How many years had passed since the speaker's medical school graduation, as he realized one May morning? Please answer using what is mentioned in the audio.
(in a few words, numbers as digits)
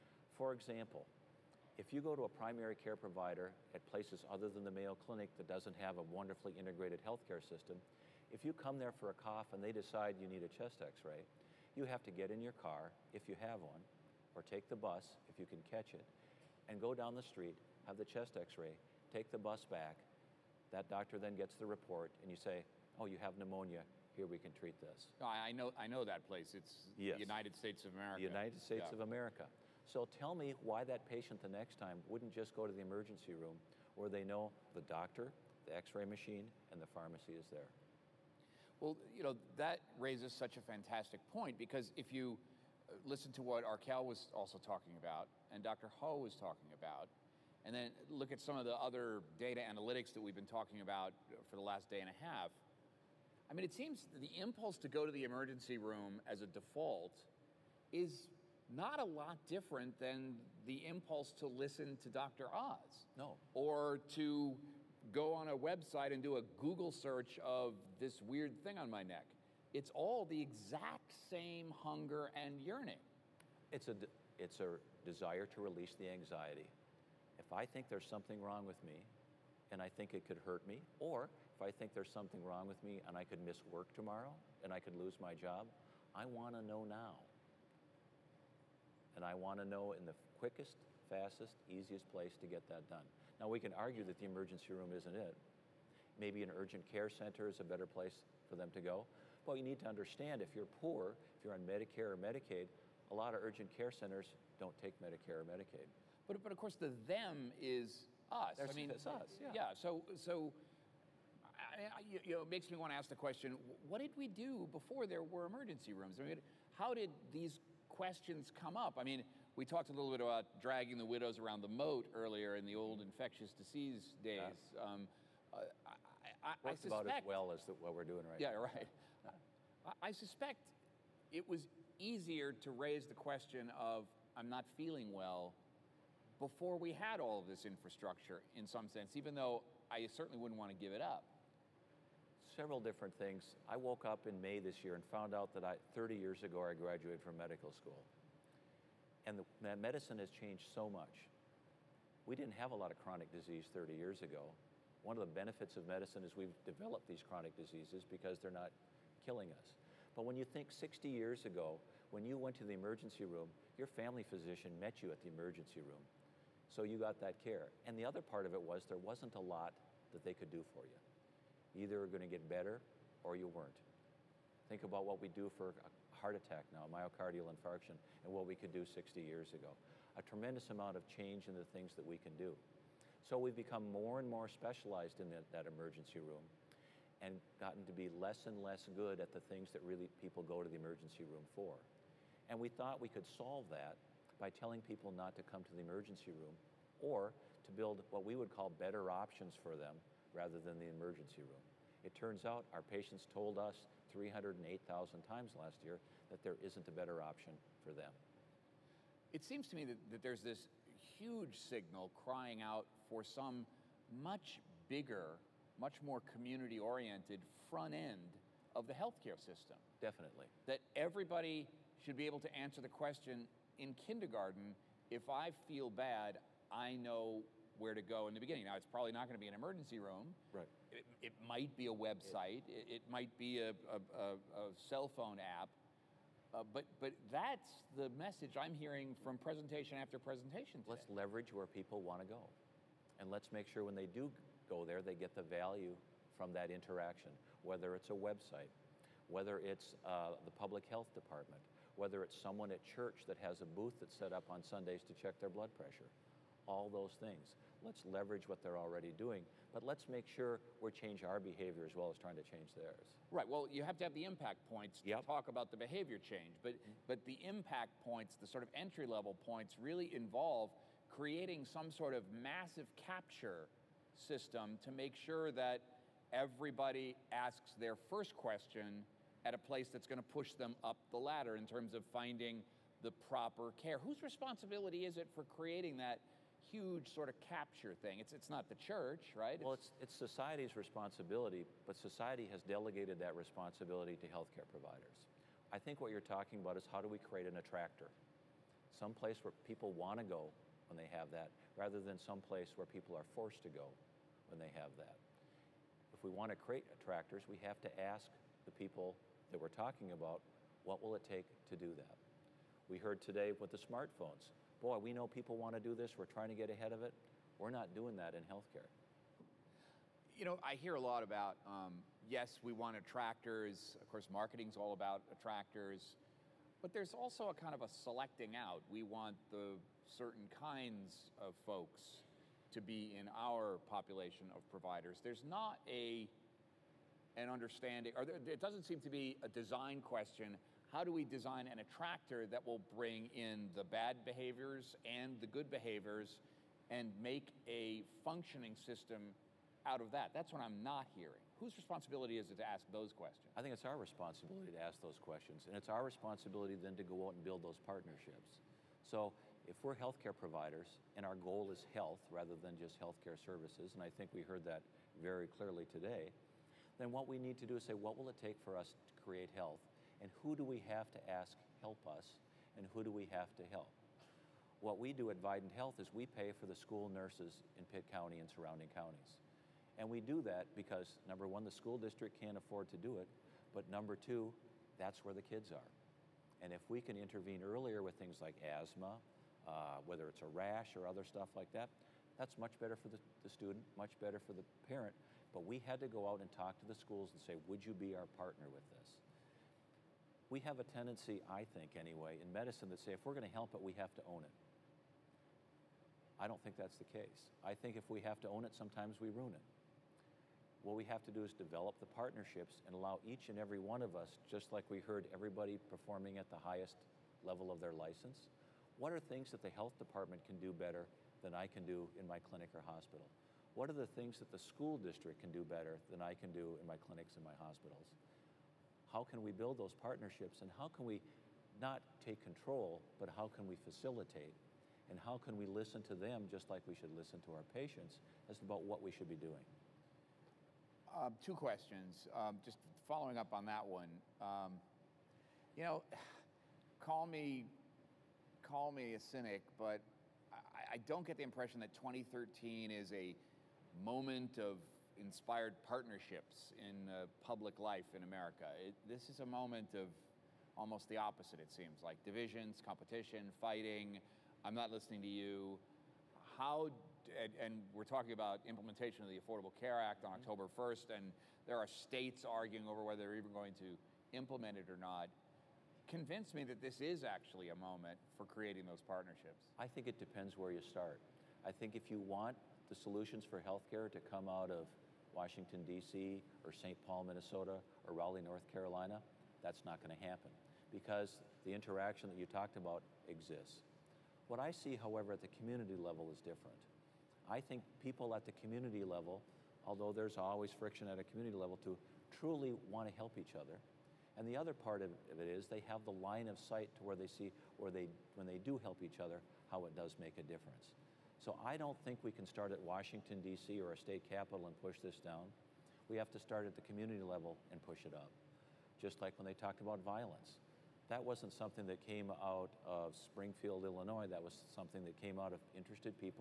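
30.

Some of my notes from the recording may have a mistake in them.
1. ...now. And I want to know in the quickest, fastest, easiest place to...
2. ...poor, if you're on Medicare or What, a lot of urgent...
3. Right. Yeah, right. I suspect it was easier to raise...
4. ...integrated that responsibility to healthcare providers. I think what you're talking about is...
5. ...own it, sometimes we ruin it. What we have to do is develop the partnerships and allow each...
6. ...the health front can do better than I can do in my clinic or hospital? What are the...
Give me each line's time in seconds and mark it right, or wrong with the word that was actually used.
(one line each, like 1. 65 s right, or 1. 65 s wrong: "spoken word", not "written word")
1. 86 s right
2. 100 s wrong: "Medicaid", not "What"
3. 128 s right
4. 292 s wrong: "delegated", not "integrated"
5. 408 s right
6. 419 s wrong: "department", not "front".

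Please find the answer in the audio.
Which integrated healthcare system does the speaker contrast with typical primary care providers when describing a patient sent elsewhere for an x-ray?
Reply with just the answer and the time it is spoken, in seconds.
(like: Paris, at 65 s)
Mayo Clinic, at 4 s.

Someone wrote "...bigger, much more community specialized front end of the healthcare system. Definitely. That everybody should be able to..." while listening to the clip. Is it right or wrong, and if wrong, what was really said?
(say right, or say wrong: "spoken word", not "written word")
wrong: "oriented", not "specialized".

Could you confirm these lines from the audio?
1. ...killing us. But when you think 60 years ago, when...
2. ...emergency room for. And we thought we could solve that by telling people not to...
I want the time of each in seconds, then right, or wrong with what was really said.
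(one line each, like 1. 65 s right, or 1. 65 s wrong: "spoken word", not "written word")
1. 159 s right
2. 190 s right.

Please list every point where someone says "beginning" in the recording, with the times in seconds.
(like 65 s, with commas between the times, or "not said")
228 s.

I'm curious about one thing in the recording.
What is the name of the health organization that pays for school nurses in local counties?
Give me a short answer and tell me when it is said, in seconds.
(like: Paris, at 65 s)
Vidant Health, at 375 s.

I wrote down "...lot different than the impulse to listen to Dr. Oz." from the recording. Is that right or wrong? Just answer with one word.
right.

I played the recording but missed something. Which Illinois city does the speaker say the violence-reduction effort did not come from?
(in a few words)
Springfield.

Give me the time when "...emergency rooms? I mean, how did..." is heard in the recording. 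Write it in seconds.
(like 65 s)
115 s.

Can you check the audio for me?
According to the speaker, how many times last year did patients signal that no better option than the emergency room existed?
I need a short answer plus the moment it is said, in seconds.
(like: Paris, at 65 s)
308,000, at 204 s.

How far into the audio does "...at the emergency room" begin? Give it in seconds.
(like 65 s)
165 s.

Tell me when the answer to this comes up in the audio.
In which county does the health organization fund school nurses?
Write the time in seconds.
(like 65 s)
377 s.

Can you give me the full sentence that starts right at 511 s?
So I don't think we can start at Washington, D.C.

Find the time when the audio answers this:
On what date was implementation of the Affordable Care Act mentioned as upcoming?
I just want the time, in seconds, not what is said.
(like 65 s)
470 s.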